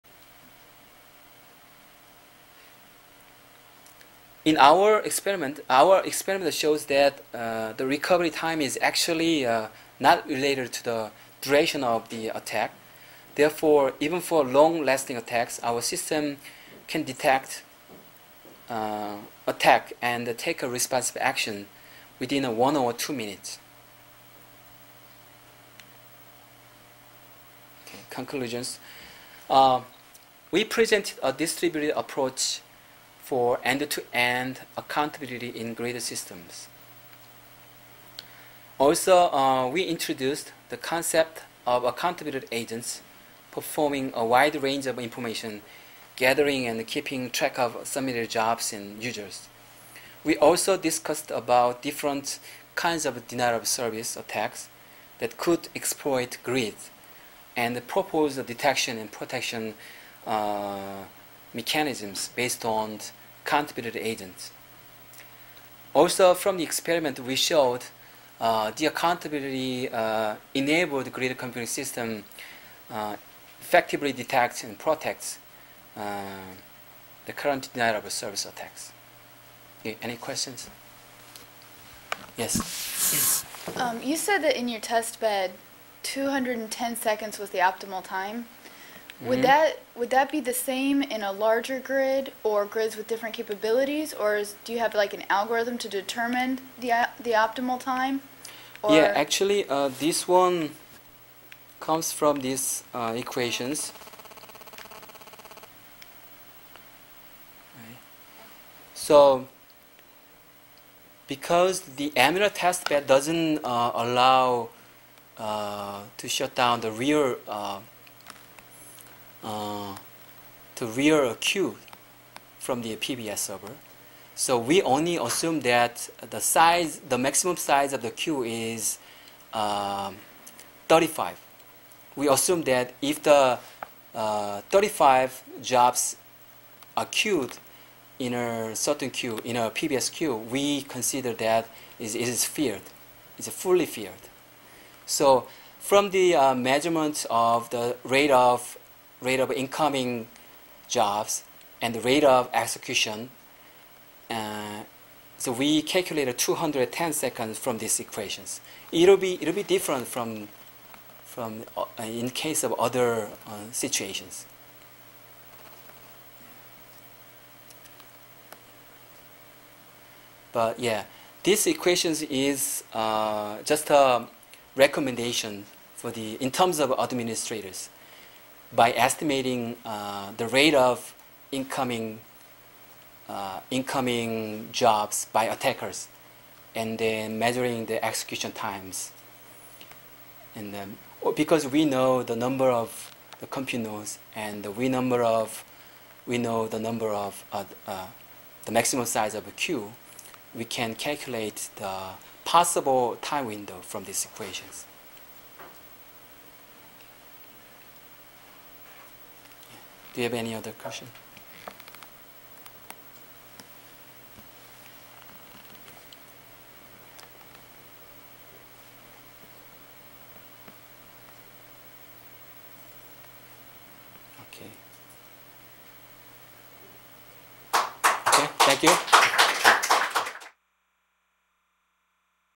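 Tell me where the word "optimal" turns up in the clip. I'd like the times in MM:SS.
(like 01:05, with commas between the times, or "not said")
01:27, 01:37.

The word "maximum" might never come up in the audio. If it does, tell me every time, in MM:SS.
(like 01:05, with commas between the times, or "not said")
02:07, 03:18.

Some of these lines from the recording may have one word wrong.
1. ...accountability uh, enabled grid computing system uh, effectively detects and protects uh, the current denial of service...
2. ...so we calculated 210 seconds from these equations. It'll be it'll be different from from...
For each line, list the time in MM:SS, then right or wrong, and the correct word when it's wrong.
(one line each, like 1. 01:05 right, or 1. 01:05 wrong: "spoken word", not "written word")
1. 01:08 right
2. 02:35 right.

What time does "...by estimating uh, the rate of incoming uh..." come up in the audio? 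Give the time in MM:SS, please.
02:58.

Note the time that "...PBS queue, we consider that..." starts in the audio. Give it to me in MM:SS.
02:19.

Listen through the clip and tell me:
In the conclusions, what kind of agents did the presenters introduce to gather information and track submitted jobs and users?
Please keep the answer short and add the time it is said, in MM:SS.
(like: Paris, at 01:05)
accountability agents, at 00:41.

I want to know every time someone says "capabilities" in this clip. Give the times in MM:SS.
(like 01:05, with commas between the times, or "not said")
01:33.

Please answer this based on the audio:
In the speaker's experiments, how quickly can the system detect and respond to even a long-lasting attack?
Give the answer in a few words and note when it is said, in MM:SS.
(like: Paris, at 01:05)
1 or 2 minutes, at 00:22.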